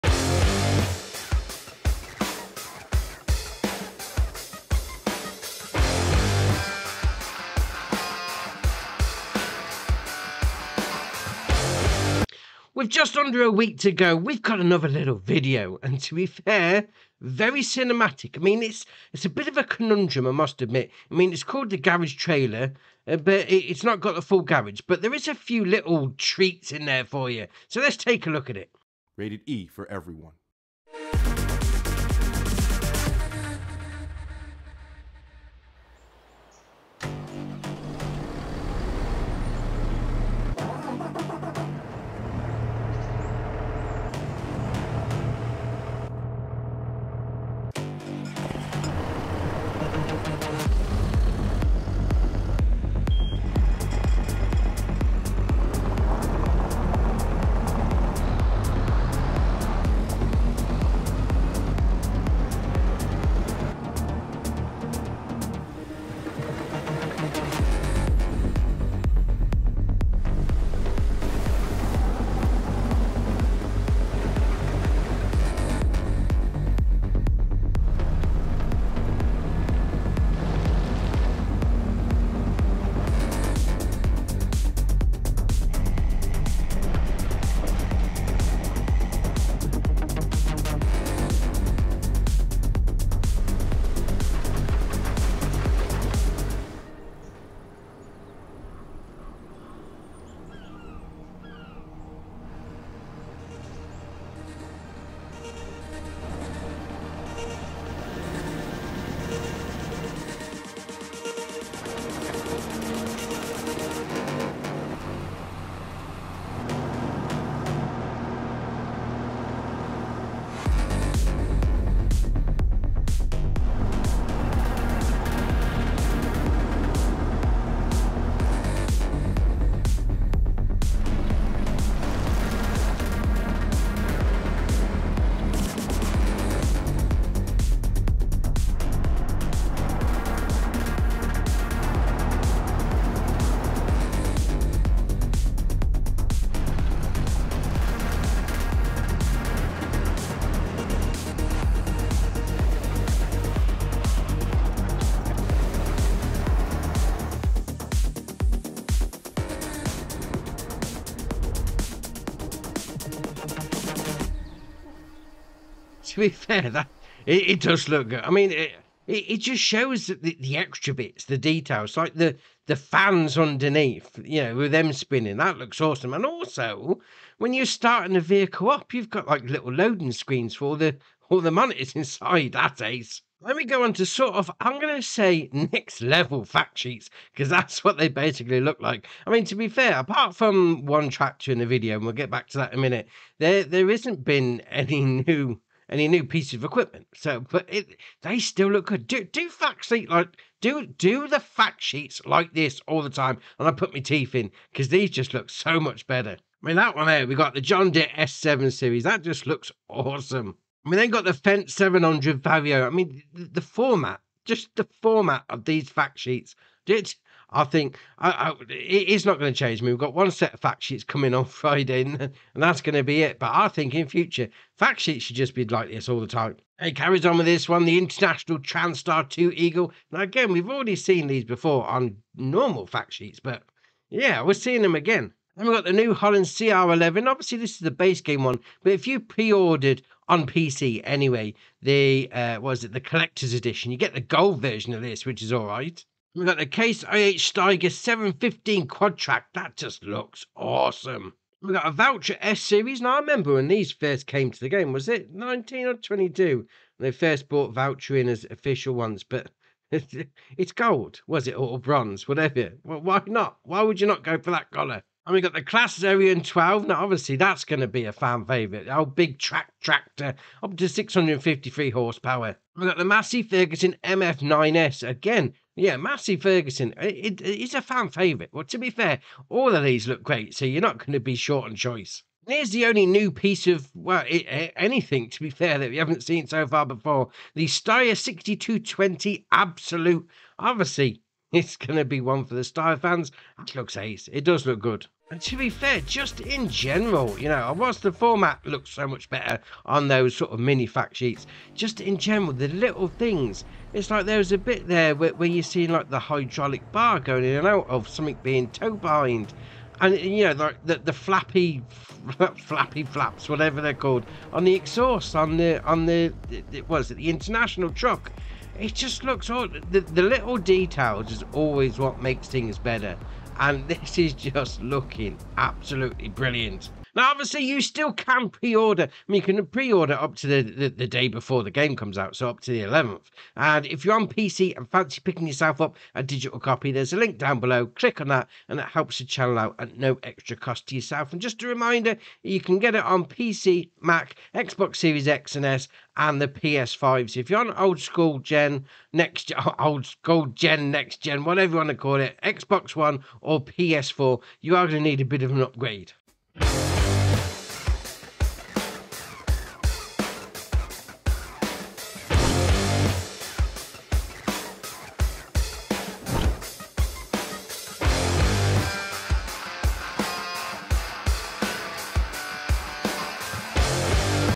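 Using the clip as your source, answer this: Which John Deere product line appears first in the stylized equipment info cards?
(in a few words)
S7 series.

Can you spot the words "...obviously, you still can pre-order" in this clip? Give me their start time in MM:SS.
05:27.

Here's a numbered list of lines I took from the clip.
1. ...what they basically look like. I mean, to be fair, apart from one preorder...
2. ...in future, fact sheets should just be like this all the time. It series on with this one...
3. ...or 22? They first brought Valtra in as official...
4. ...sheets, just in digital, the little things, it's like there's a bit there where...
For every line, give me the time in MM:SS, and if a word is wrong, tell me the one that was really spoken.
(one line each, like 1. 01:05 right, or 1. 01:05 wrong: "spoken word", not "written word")
1. 03:07 wrong: "chapter", not "preorder"
2. 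03:43 wrong: "carries", not "series"
3. 04:15 right
4. 05:01 wrong: "general", not "digital".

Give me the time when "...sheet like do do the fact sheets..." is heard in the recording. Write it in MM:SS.
03:19.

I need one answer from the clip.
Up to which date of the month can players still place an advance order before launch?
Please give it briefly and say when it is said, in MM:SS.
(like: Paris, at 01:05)
the 11th, at 05:32.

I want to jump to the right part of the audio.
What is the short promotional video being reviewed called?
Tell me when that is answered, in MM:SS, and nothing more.
00:21.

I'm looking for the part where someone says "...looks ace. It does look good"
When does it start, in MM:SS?
04:53.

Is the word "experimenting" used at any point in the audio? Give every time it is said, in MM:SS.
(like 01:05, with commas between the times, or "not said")
not said.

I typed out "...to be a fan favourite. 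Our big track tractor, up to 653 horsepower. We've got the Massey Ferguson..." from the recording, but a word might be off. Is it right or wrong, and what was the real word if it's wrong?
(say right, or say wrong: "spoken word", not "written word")
right.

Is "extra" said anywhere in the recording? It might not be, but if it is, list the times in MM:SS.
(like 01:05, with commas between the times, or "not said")
02:50, 05:40.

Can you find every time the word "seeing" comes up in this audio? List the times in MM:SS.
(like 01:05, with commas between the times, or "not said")
03:54, 05:05.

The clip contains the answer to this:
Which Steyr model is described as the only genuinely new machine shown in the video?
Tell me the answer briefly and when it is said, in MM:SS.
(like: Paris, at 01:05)
Steyr 6220 Absolut, at 04:47.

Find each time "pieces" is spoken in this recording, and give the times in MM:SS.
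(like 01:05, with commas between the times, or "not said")
03:16, 04:43.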